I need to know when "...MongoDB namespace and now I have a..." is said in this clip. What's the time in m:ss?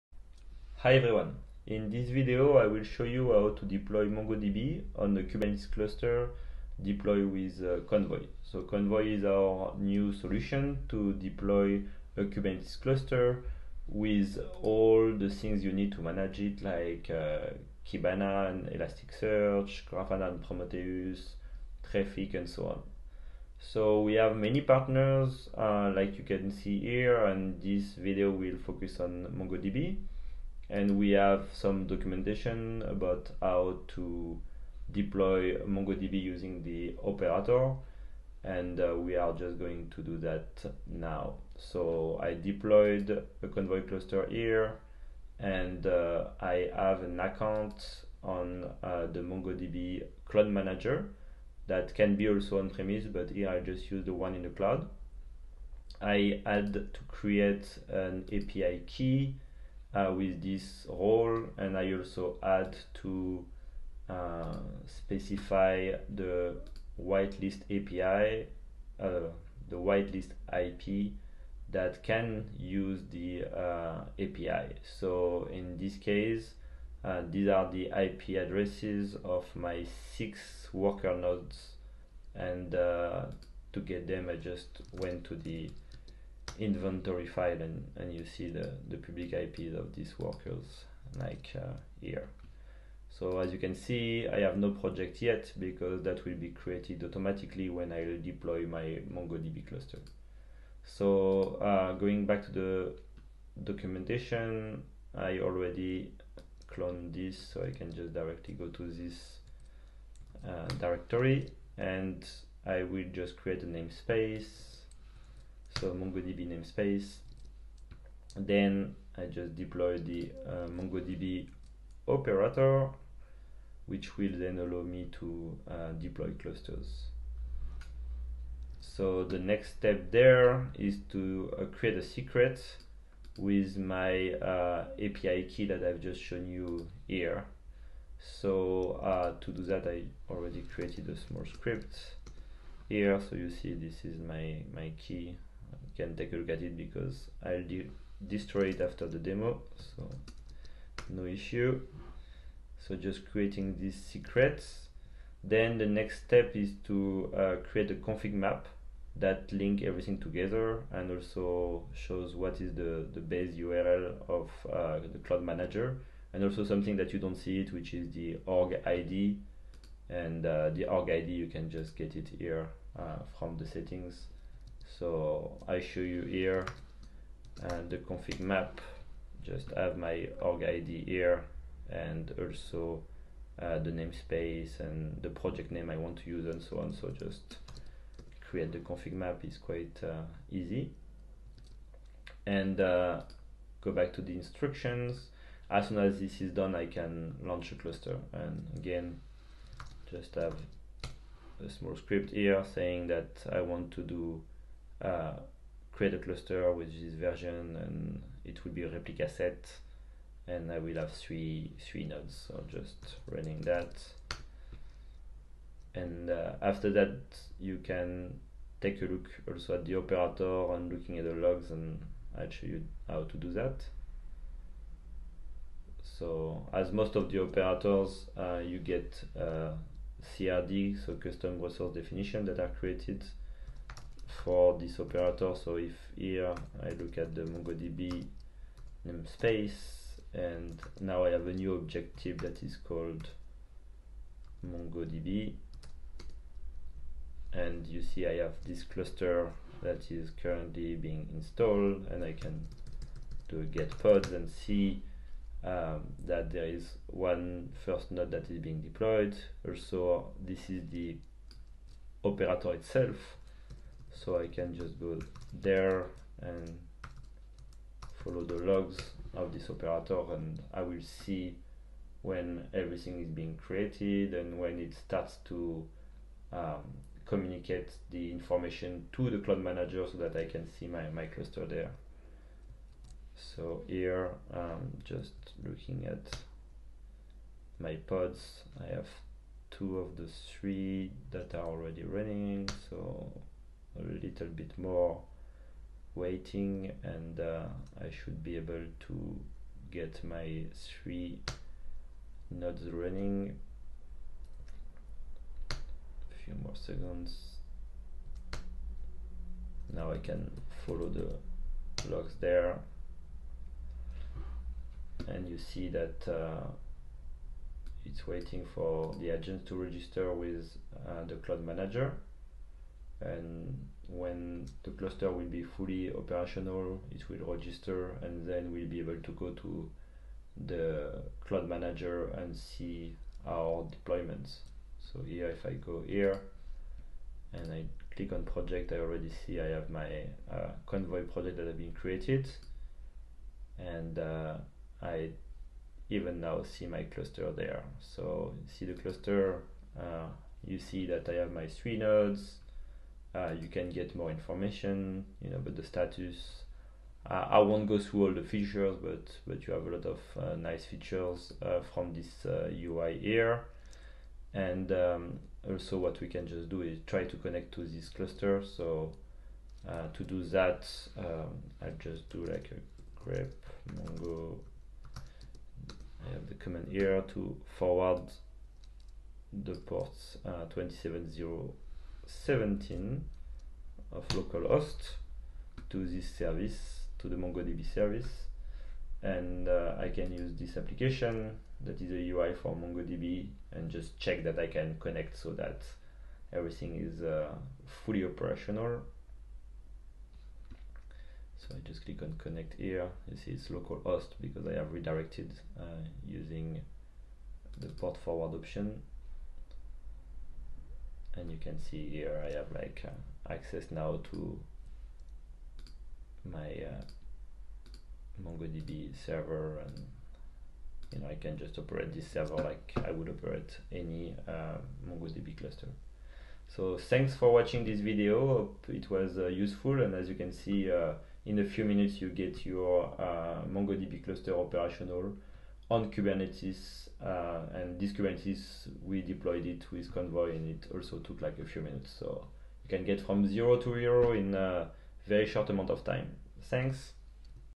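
3:57.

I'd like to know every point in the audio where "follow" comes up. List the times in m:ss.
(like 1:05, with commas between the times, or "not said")
4:28, 5:10.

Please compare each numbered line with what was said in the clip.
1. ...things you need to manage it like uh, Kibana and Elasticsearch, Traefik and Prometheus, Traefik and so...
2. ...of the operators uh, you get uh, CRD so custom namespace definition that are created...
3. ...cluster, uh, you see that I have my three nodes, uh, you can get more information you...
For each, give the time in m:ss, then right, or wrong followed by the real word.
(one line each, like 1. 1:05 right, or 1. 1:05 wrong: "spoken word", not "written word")
1. 0:15 wrong: "Grafana", not "Traefik"
2. 3:47 wrong: "resource", not "namespace"
3. 5:48 right.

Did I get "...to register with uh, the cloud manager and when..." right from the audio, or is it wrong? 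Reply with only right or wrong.
right.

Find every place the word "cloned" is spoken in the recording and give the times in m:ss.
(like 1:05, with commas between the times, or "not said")
1:46.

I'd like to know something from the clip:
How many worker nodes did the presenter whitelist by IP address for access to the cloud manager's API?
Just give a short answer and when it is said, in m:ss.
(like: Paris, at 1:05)
6, at 1:20.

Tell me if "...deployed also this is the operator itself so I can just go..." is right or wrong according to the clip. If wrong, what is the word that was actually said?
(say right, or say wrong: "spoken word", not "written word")
right.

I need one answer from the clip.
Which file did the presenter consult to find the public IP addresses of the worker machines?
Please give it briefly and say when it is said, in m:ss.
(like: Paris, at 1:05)
inventory file, at 1:26.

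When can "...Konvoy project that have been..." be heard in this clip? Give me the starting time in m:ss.
5:40.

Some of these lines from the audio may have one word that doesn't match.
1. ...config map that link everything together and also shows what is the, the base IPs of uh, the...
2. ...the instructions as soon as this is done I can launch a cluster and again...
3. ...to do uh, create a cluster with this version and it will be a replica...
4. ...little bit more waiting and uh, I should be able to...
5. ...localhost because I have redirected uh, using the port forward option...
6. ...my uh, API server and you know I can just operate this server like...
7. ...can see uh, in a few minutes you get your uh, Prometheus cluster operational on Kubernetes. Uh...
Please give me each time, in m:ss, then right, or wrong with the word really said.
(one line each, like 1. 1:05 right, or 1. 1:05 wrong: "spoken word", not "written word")
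1. 2:37 wrong: "URL", not "IPs"
2. 3:14 right
3. 3:23 right
4. 4:54 right
5. 6:43 right
6. 6:56 wrong: "MongoDB", not "API"
7. 7:10 wrong: "MongoDB", not "Prometheus".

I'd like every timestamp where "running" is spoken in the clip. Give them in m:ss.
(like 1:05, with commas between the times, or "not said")
3:33, 4:52, 5:02.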